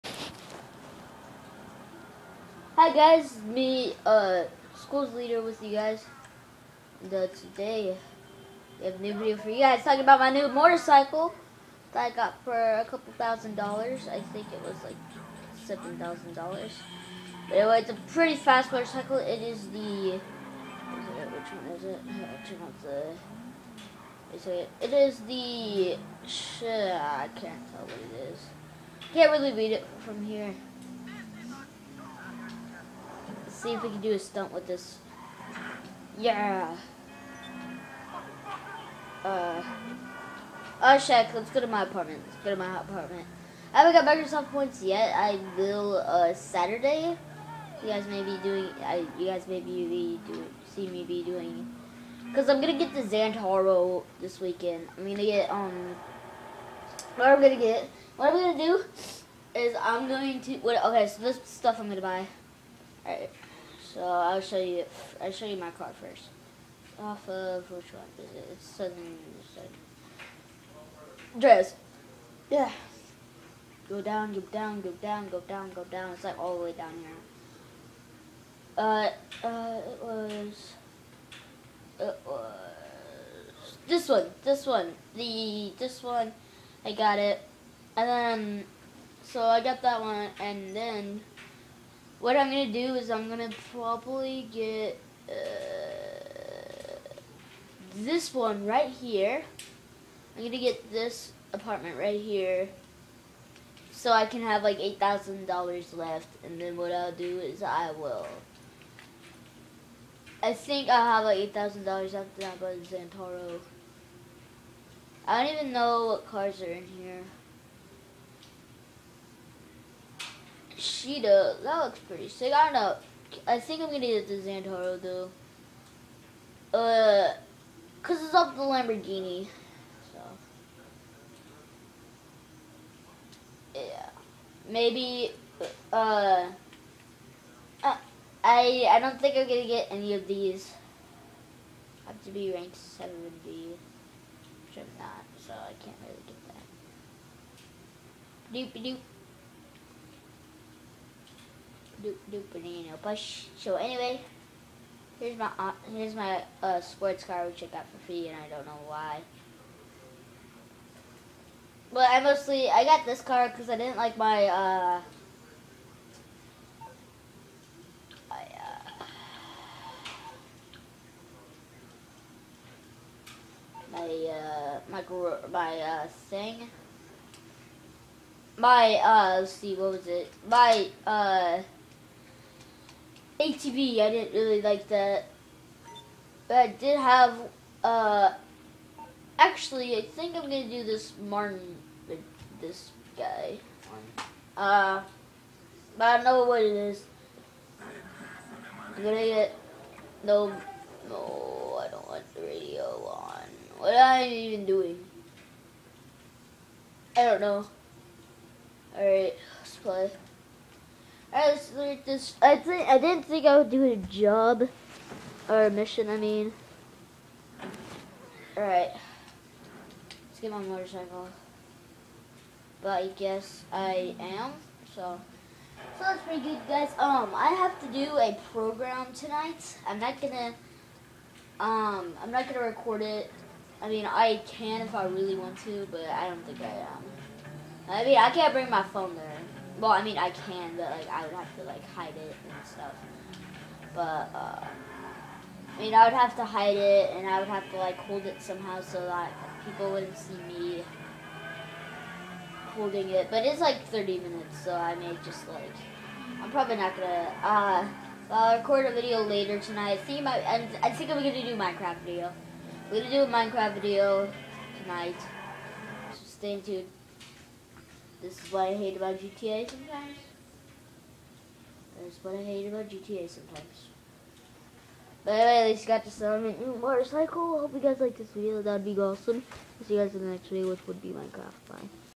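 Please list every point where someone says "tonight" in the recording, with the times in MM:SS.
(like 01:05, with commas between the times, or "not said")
03:49, 04:19, 04:24.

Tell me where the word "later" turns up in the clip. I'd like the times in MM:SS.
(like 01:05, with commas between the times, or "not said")
04:19.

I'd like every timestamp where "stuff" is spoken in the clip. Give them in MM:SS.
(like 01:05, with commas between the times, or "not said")
01:01, 04:02.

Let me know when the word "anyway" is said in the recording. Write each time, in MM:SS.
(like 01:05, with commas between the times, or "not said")
00:17, 02:33, 04:35.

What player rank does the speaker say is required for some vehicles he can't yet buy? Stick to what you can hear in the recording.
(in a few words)
70.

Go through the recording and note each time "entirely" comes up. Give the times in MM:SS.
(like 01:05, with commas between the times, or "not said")
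not said.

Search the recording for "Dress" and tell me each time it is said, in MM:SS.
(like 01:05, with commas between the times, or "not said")
01:11.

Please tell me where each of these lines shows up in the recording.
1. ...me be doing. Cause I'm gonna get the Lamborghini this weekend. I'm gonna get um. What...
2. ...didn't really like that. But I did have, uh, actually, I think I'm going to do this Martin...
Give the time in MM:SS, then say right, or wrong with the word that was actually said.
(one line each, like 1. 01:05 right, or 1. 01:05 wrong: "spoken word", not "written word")
1. 00:50 wrong: "Zentorno", not "Lamborghini"
2. 03:04 right.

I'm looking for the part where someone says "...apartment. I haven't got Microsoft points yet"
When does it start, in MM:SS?
00:42.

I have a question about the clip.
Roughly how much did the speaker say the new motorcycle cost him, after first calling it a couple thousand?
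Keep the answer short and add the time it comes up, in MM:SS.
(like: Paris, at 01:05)
$7,000, at 00:15.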